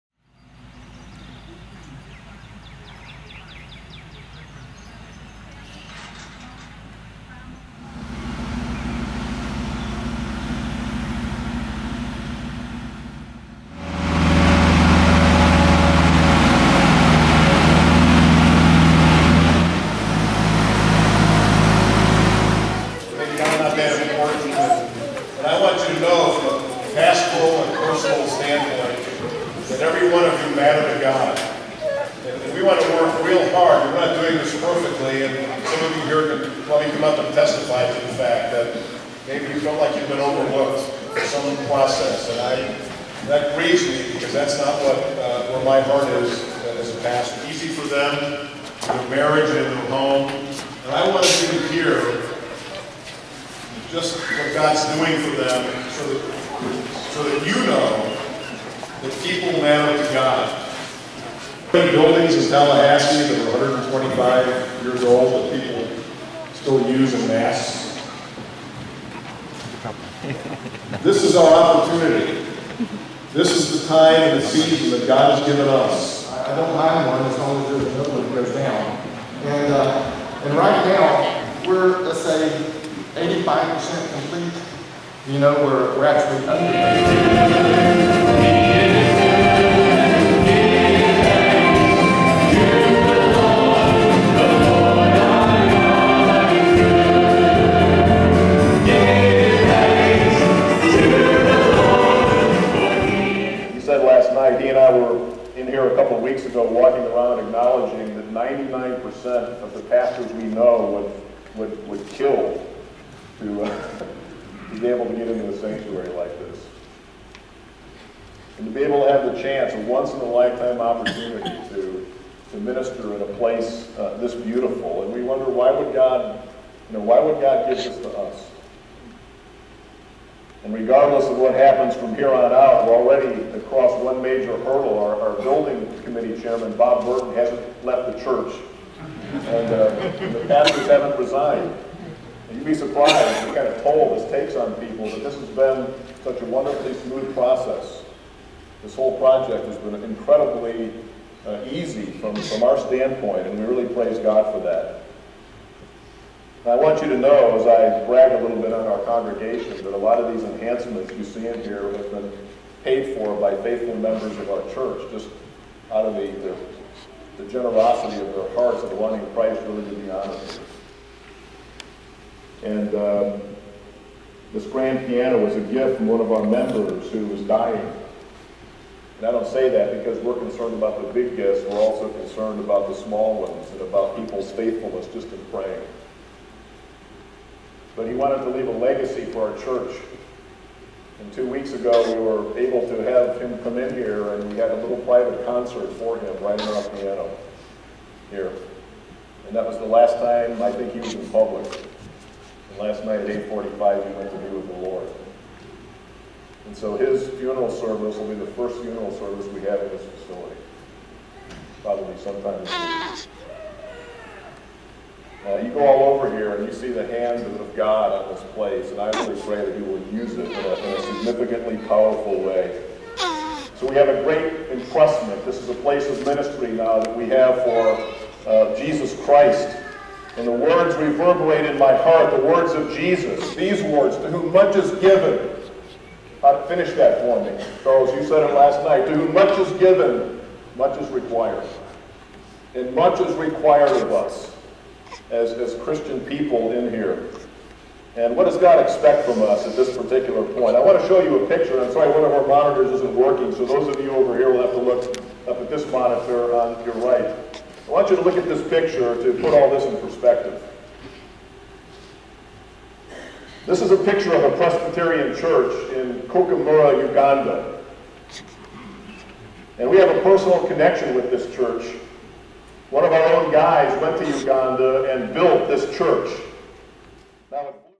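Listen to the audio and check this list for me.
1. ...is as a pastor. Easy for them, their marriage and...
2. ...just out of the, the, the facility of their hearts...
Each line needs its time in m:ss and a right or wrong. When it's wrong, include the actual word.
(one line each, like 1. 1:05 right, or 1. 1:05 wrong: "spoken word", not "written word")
1. 0:46 right
2. 2:45 wrong: "generosity", not "facility".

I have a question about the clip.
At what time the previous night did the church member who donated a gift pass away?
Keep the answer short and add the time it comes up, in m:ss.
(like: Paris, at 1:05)
8:45, at 3:23.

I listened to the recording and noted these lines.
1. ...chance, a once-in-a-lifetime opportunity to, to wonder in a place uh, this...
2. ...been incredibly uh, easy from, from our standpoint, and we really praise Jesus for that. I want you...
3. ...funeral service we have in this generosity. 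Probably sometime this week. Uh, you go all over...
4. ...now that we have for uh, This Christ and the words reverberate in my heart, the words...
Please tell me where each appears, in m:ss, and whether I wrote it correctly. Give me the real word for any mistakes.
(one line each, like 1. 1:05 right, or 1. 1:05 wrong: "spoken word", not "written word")
1. 1:59 wrong: "minister", not "wonder"
2. 2:29 wrong: "God", not "Jesus"
3. 3:28 wrong: "facility", not "generosity"
4. 3:46 wrong: "Jesus", not "This".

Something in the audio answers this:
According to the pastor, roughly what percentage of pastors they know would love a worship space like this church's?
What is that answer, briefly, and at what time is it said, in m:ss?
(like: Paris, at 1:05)
99%, at 1:48.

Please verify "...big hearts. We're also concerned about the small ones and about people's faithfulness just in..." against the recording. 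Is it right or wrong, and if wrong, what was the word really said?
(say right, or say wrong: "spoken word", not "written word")
wrong: "gifts", not "hearts".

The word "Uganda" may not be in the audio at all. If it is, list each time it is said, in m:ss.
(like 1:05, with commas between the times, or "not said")
4:27, 4:34.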